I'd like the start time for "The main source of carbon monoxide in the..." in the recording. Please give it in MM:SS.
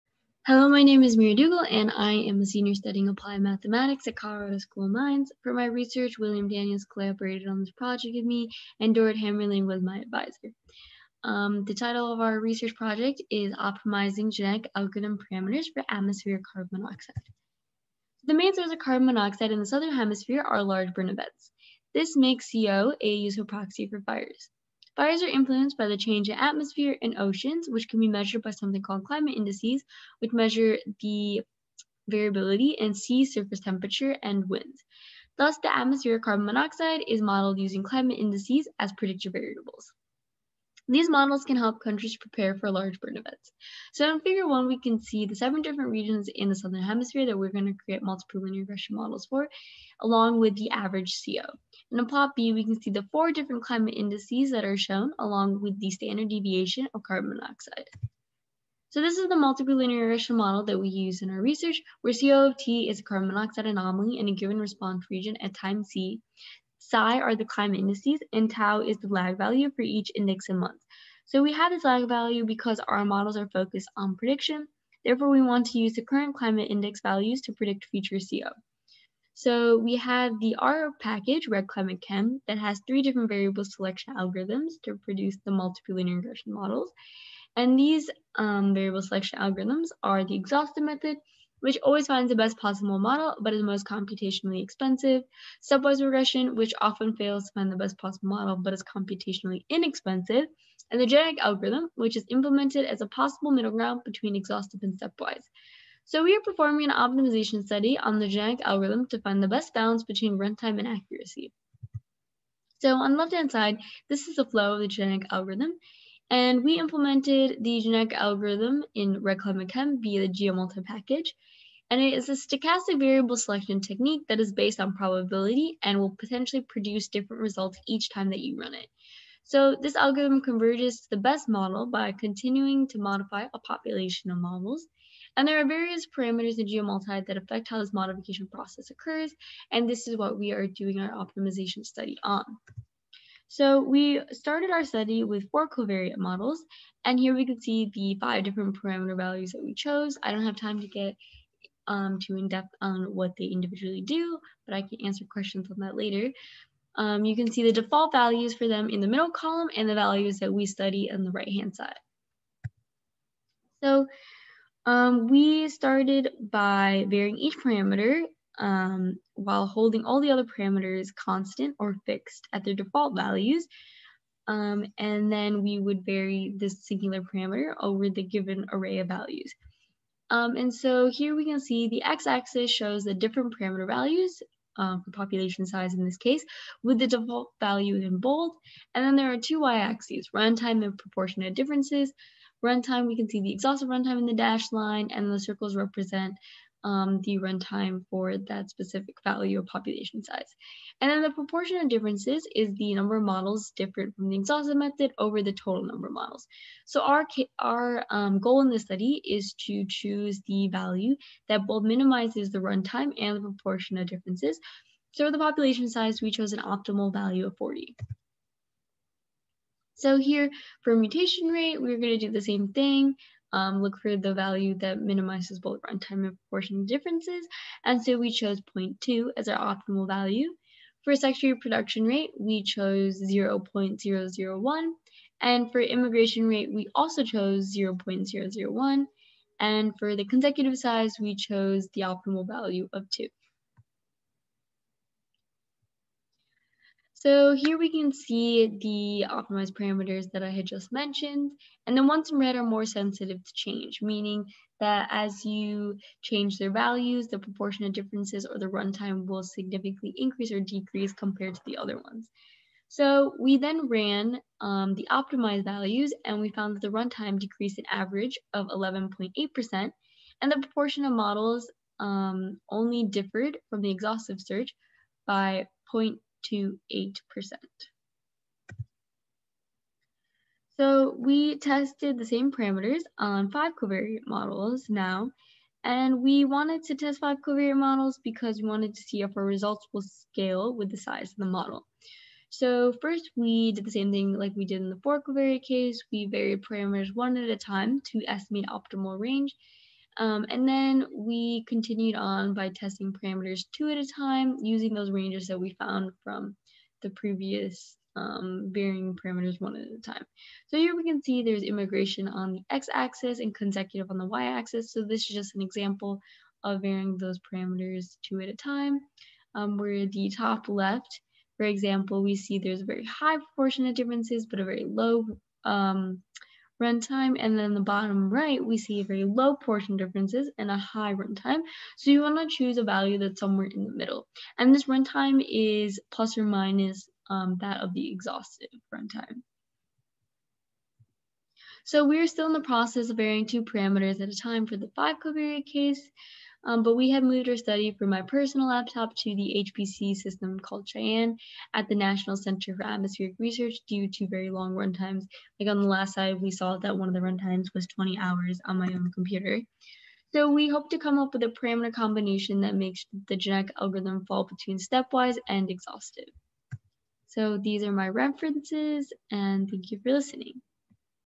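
00:18.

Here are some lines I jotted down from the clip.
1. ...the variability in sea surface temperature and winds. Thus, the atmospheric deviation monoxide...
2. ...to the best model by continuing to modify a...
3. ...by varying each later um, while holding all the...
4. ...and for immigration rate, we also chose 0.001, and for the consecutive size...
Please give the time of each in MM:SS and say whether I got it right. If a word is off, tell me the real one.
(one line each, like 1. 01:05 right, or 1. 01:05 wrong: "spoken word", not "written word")
1. 00:30 wrong: "carbon", not "deviation"
2. 02:11 right
3. 02:46 wrong: "parameter", not "later"
4. 03:55 right.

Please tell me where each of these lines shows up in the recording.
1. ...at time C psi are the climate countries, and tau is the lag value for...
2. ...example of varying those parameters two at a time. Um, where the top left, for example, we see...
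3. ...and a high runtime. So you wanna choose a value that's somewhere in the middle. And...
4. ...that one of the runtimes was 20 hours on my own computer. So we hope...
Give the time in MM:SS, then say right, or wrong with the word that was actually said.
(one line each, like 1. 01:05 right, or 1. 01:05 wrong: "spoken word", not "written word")
1. 01:05 wrong: "indices", not "countries"
2. 05:15 right
3. 05:30 right
4. 05:56 right.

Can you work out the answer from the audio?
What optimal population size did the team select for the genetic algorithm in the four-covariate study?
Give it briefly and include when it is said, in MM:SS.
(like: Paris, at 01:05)
40, at 03:37.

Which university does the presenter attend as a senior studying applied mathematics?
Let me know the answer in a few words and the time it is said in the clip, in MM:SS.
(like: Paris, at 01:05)
Colorado School of Mines, at 00:04.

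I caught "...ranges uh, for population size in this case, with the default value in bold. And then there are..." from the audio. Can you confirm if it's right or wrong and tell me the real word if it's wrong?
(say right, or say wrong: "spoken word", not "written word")
wrong: "values", not "ranges".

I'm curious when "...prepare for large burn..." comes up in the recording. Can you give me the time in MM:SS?
00:42.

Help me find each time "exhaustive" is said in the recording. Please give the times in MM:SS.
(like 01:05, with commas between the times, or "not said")
01:30, 01:44, 03:13, 03:24, 04:33, 05:38, 06:05.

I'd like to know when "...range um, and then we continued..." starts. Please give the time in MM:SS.
04:59.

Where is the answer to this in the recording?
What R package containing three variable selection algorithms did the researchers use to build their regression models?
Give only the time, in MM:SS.
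01:21.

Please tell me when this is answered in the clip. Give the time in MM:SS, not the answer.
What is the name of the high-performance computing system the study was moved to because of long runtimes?
05:50.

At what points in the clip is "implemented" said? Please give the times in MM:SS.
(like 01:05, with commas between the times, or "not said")
01:42, 01:56.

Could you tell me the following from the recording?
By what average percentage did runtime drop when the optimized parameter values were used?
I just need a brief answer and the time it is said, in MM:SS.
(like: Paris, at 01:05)
11.8%, at 04:28.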